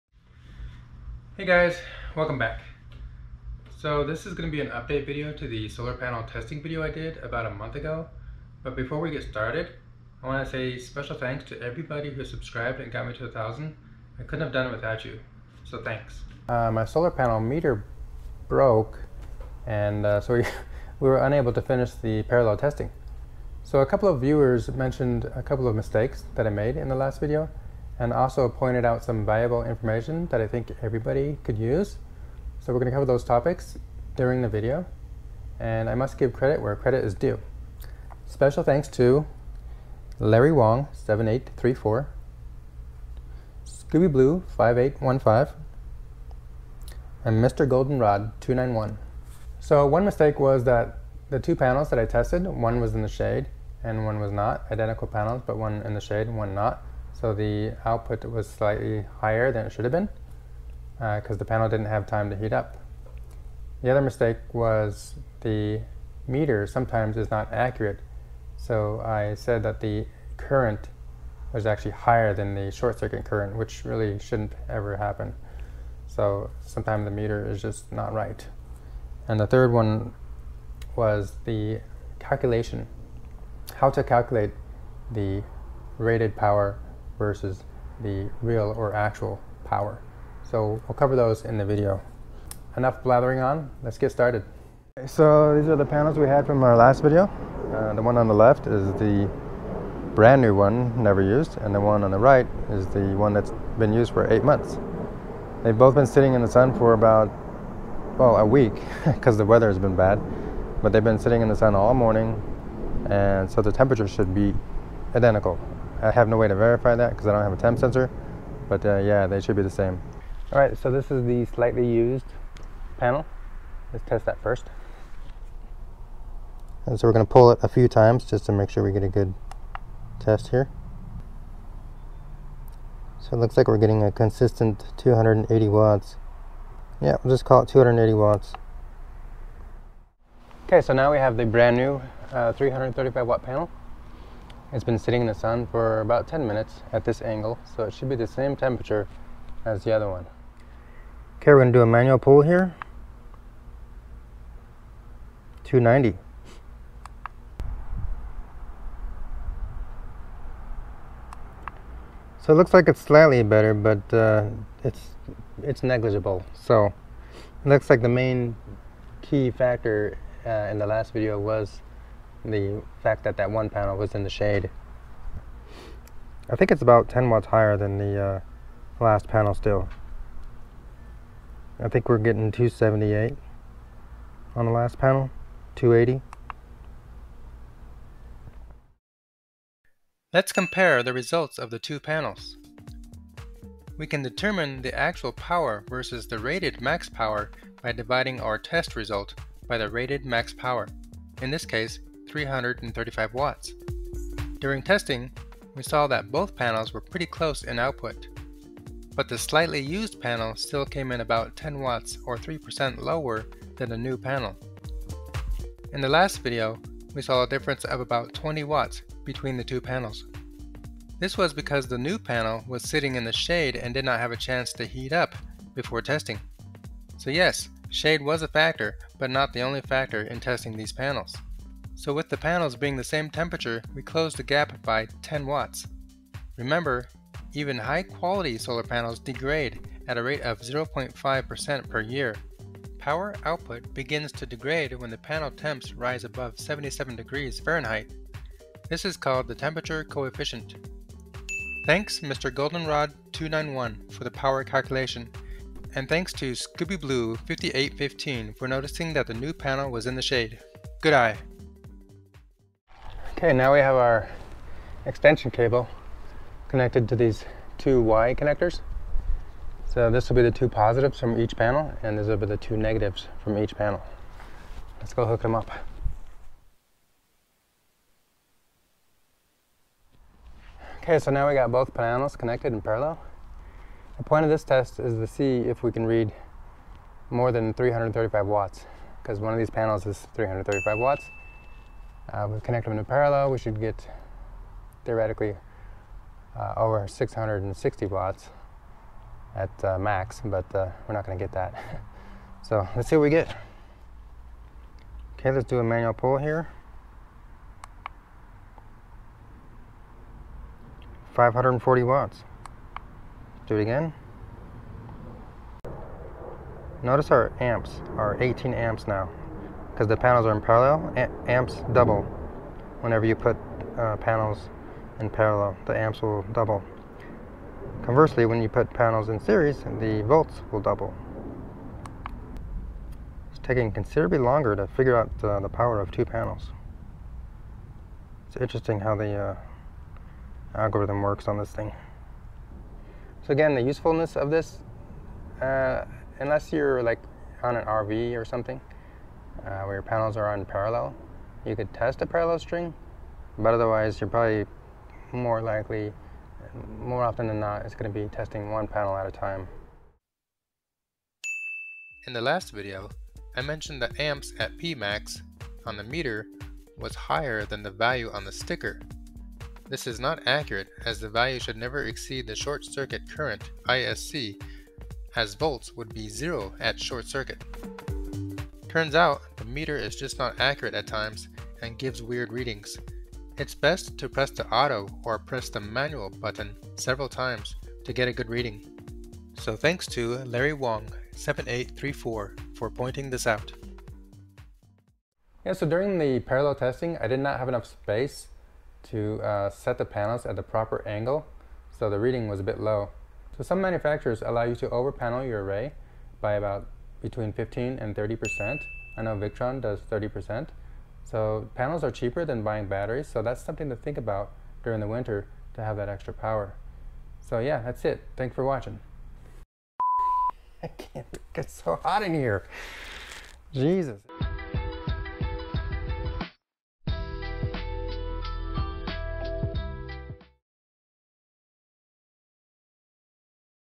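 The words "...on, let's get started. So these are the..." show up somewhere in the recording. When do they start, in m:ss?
1:33.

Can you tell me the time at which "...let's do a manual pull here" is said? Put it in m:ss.
5:05.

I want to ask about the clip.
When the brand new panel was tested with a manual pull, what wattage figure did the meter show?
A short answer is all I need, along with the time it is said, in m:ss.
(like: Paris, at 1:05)
290, at 2:35.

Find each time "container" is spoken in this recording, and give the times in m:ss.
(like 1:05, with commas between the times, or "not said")
not said.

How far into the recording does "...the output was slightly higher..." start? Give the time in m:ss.
0:57.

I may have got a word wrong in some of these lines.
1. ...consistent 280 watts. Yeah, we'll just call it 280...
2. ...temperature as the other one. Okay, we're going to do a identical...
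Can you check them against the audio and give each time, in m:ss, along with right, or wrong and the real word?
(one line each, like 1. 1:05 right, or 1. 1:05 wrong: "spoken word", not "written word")
1. 2:14 right
2. 2:28 wrong: "manual", not "identical".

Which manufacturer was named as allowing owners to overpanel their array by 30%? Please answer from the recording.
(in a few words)
Victron.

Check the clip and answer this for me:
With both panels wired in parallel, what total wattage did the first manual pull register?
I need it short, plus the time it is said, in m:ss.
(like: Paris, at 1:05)
540 watts, at 5:11.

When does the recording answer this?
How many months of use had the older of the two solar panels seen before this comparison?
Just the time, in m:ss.
1:44.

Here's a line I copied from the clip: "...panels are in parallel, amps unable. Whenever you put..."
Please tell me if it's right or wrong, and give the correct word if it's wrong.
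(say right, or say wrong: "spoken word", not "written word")
wrong: "double", not "unable".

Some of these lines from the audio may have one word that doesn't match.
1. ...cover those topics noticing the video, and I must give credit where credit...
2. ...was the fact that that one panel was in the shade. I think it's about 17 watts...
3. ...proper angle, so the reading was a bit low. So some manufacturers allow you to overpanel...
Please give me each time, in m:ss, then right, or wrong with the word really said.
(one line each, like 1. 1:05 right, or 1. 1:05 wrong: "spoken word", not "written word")
1. 0:32 wrong: "during", not "noticing"
2. 2:51 wrong: "10", not "17"
3. 6:40 right.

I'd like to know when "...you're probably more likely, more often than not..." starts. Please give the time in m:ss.
5:54.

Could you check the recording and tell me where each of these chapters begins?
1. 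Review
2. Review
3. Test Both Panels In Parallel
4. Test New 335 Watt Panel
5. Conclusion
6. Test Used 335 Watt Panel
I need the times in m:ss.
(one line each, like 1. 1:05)
1. 6:00
2. 3:08
3. 4:22
4. 2:19
5. 6:34
6. 1:59.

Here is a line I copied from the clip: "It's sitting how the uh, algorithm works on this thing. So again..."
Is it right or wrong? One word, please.
wrong.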